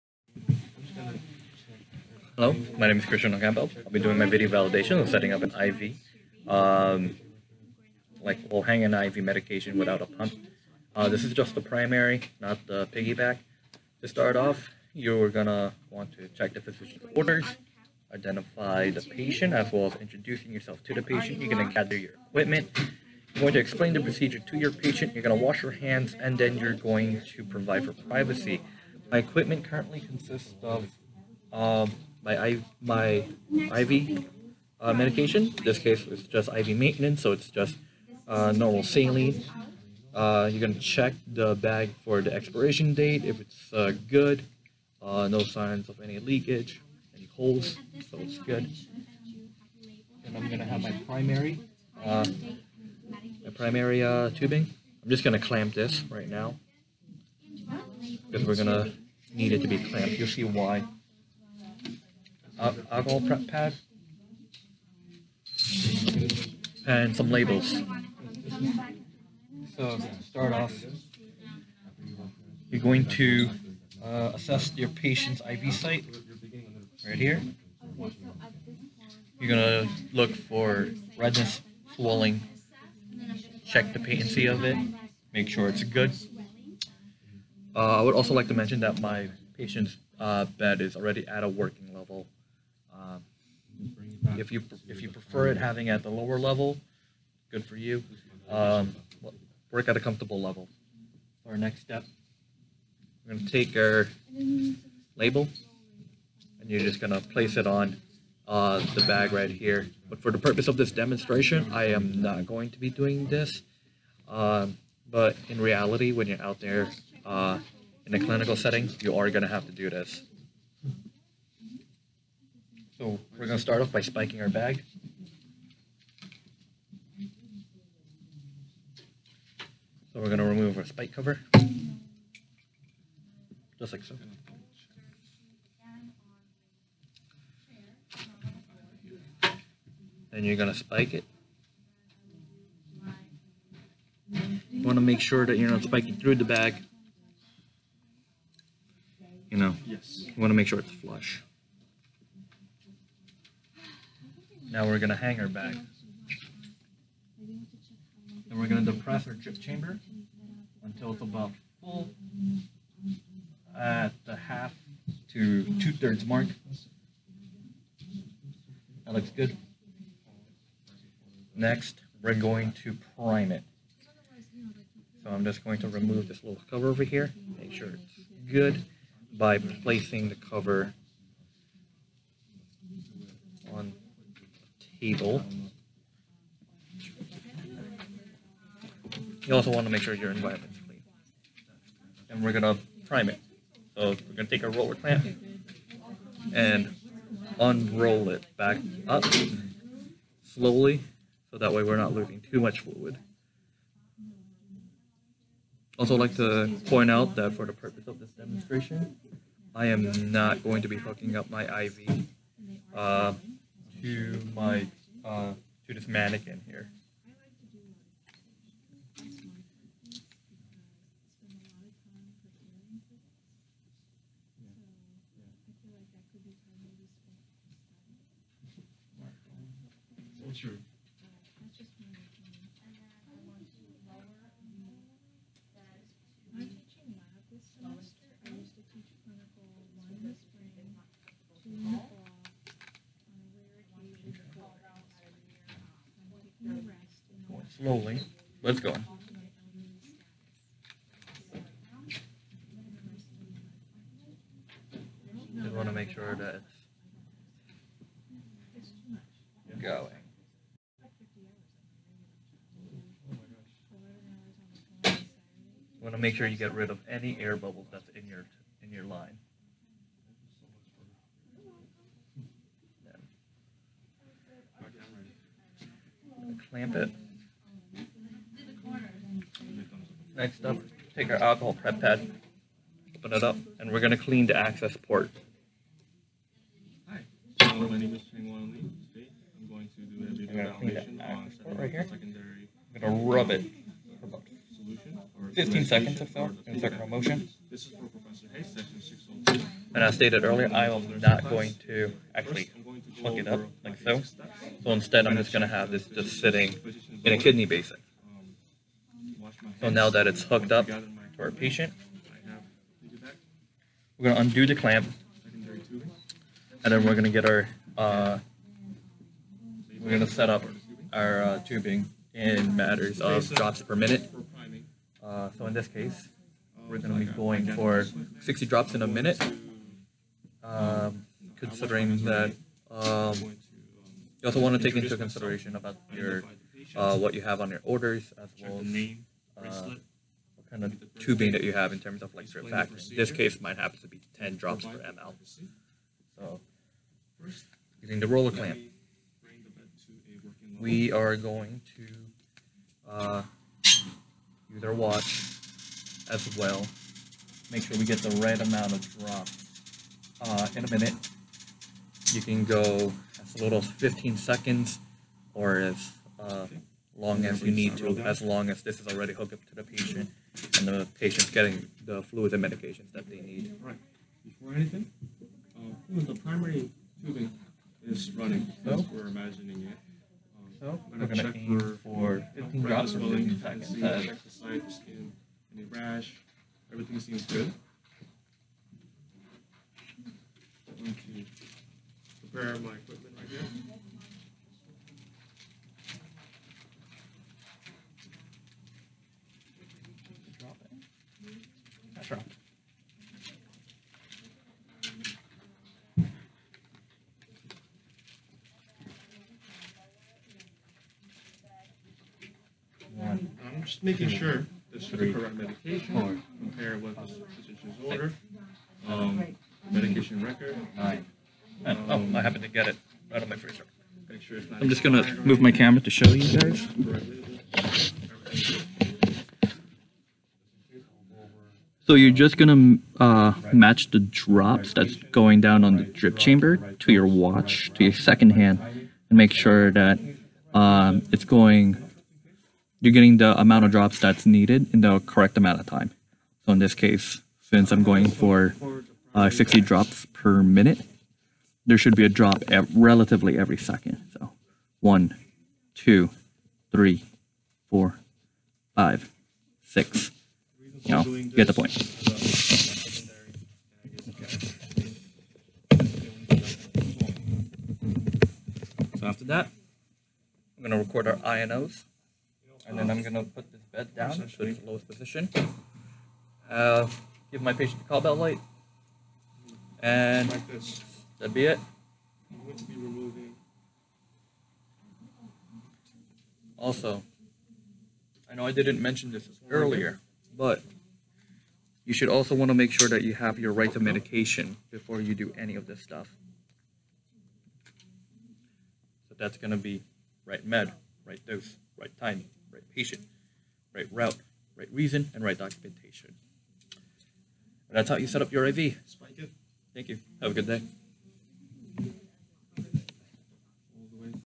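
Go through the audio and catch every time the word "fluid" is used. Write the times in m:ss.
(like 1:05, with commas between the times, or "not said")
3:22, 6:12.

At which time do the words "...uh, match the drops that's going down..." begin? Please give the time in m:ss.
7:13.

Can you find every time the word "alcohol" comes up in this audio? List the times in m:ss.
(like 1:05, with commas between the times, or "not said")
1:02, 4:41.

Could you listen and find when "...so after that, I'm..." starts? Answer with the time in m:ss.
7:49.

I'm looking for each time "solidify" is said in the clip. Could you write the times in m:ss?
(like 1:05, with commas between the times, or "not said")
not said.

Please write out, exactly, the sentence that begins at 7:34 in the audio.
So one, two, three, four, five, six, you know, you get the point.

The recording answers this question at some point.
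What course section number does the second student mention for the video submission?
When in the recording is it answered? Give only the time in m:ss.
4:58.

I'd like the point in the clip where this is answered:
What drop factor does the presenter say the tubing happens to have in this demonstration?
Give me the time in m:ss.
5:44.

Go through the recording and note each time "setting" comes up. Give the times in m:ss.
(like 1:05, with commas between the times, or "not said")
0:05, 1:58.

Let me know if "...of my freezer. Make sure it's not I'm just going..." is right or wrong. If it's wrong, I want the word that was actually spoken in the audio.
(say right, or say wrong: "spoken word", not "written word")
right.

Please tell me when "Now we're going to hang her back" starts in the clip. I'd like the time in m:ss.
2:34.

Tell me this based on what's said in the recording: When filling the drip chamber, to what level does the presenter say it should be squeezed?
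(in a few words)
half to two-thirds.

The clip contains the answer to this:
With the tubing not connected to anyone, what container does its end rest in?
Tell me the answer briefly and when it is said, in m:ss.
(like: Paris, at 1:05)
kidney basin, at 5:07.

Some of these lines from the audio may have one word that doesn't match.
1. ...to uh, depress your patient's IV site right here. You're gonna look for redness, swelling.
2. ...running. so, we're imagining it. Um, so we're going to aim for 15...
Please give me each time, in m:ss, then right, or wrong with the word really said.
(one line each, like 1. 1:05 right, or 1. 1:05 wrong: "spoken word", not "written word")
1. 1:13 wrong: "assess", not "depress"
2. 6:18 right.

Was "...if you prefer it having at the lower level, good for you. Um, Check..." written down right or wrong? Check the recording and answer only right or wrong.
wrong.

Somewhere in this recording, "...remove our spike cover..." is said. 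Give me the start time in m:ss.
2:10.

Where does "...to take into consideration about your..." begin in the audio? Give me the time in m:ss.
5:34.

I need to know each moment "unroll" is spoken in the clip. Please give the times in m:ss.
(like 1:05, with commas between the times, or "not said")
3:17.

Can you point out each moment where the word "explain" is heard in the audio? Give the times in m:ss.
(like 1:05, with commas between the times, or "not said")
0:23.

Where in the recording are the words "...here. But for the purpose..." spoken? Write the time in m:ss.
1:49.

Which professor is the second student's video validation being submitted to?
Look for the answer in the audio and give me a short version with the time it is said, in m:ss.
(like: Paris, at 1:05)
Professor Hayes, at 4:58.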